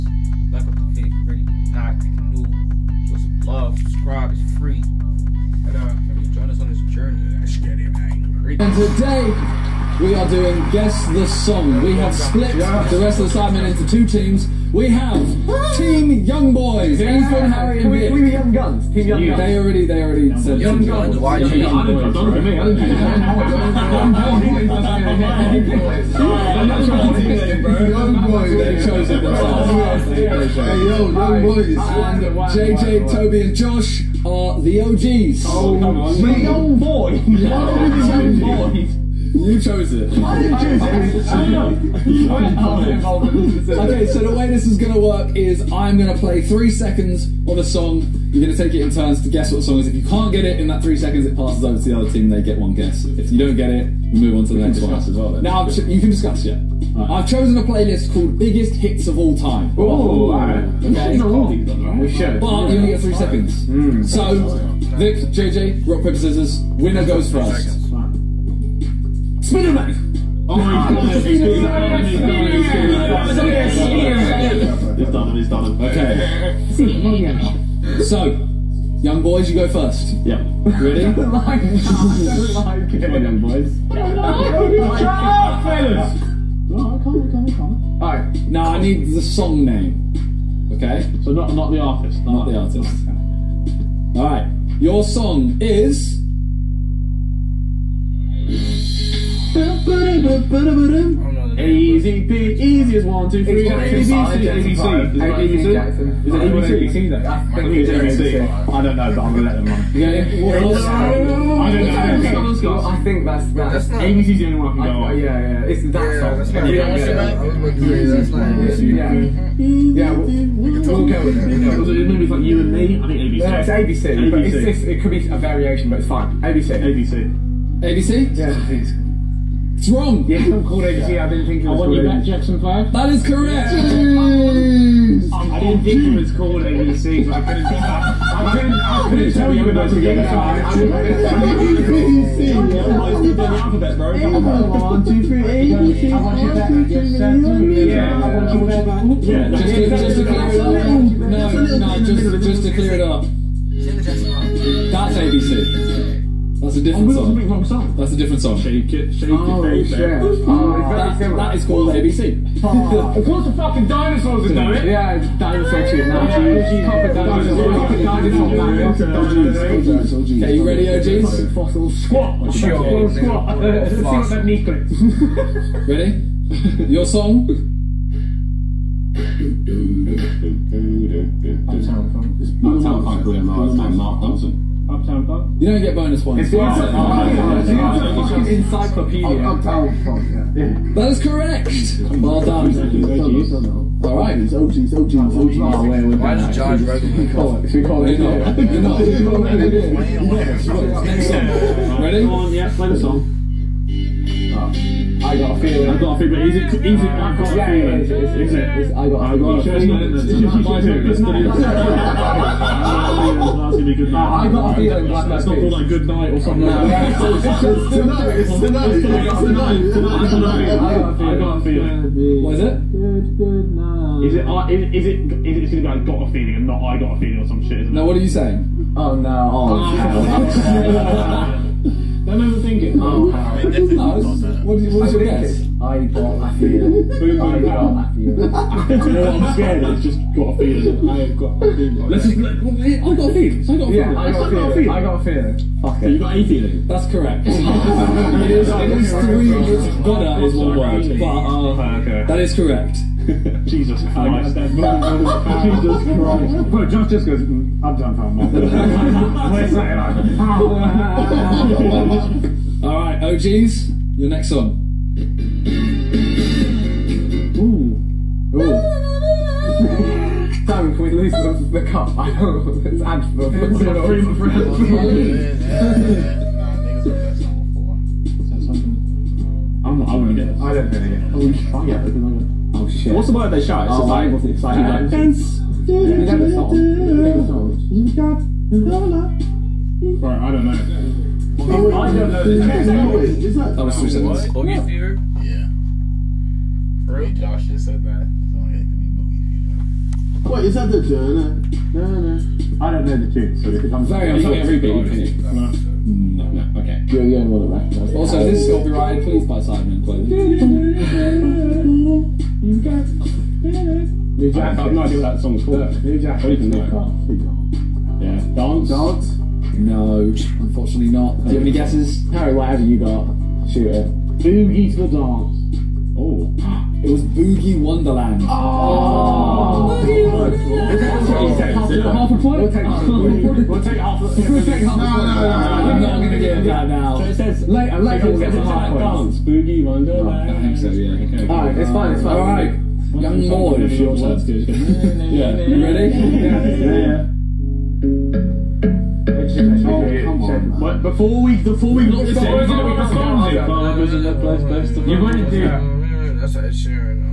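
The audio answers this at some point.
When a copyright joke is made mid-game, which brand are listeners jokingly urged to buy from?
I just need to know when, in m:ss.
5:09.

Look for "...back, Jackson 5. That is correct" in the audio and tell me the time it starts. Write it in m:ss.
2:12.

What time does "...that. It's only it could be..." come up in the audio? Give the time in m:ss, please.
4:58.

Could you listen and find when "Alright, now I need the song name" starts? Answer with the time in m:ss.
1:28.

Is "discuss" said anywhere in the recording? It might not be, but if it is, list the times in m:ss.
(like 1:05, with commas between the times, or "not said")
0:56.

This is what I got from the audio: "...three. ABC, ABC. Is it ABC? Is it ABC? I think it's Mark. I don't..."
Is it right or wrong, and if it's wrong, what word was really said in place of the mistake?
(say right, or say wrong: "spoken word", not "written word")
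wrong: "ABC", not "Mark".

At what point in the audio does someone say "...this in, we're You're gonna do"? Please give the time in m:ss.
5:52.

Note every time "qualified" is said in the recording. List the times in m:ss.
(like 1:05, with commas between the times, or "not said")
not said.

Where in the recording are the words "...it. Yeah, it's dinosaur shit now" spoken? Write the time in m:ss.
2:44.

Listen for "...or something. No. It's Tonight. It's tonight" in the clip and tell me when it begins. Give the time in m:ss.
3:36.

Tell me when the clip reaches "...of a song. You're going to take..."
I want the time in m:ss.
0:47.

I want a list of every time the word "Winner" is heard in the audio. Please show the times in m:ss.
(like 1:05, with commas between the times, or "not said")
1:06.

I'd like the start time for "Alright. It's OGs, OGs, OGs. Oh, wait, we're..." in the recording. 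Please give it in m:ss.
3:14.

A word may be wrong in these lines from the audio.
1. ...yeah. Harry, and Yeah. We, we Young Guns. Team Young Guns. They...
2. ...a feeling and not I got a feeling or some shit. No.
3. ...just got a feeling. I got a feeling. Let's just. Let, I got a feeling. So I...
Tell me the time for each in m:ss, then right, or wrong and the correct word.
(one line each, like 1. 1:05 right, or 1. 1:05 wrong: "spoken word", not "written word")
1. 0:17 wrong: "Vik", not "Yeah"
2. 3:46 right
3. 4:00 right.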